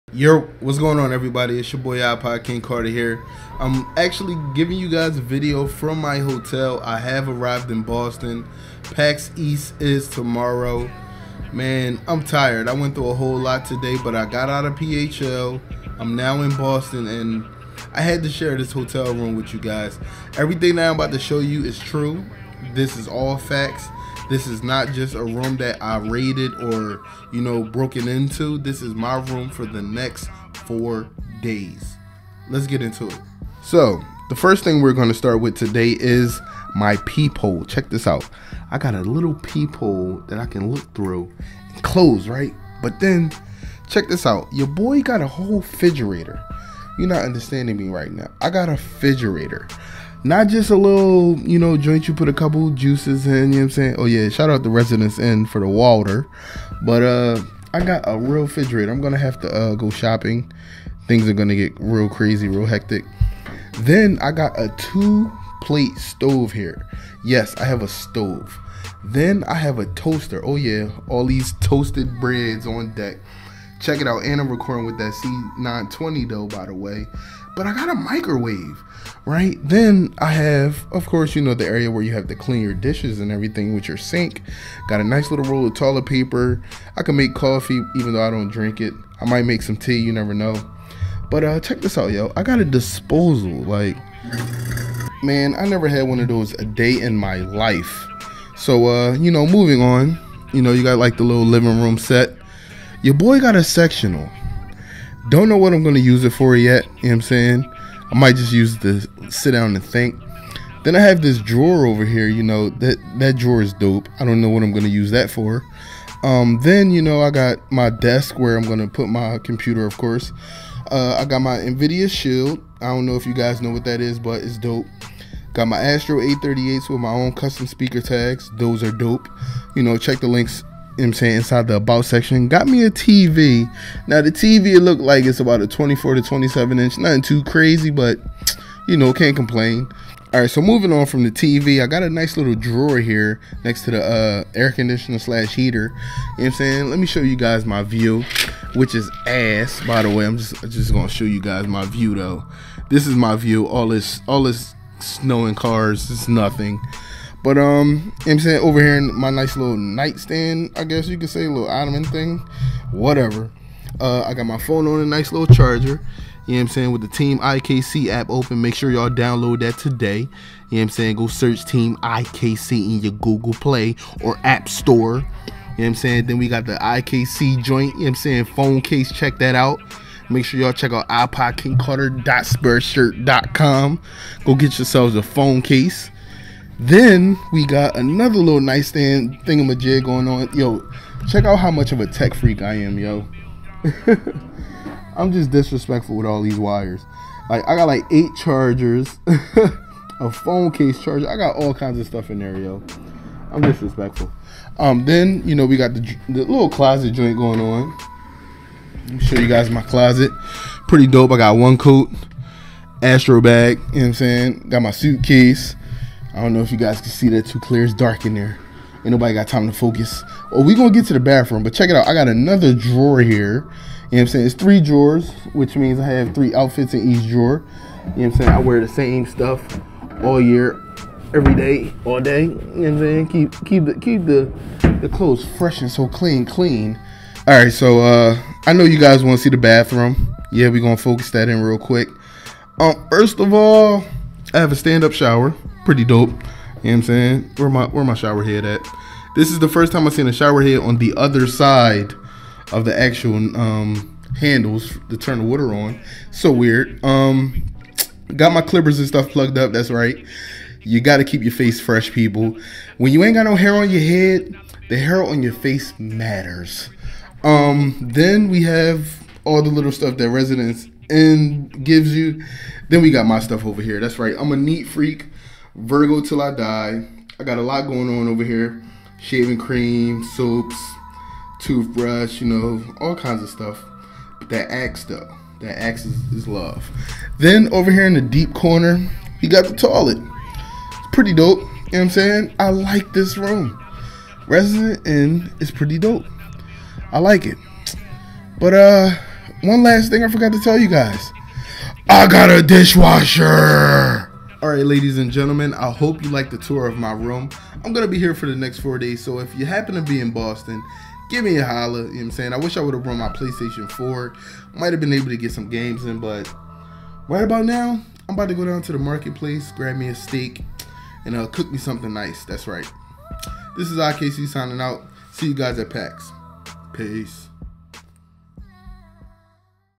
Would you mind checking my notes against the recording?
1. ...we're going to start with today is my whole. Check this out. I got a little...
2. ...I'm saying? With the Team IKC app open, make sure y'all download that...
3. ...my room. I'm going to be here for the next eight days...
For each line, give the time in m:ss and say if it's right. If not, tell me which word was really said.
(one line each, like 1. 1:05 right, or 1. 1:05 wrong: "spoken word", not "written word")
1. 0:34 wrong: "peephole", not "whole"
2. 2:46 right
3. 5:06 wrong: "four", not "eight".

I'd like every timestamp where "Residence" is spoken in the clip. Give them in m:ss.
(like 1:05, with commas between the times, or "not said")
0:54, 4:30, 4:54.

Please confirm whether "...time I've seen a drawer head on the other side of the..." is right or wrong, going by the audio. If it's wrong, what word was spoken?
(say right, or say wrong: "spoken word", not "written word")
wrong: "shower", not "drawer".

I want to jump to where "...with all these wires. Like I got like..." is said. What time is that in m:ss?
3:16.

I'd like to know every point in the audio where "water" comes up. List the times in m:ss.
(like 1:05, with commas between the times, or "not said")
0:55, 4:15.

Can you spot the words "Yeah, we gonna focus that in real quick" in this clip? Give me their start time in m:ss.
4:00.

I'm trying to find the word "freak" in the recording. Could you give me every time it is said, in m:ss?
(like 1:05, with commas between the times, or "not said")
3:12, 4:34.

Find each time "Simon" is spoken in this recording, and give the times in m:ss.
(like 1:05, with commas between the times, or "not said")
not said.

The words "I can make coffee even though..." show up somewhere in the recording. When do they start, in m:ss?
1:26.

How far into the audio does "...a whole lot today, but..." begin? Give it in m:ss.
0:13.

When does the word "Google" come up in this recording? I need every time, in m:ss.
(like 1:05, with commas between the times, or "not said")
2:53.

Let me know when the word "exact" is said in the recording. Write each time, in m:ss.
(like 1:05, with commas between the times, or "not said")
not said.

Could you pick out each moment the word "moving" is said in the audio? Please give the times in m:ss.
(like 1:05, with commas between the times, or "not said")
1:39, 2:20.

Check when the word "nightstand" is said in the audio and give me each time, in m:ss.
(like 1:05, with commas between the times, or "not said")
2:39, 3:08.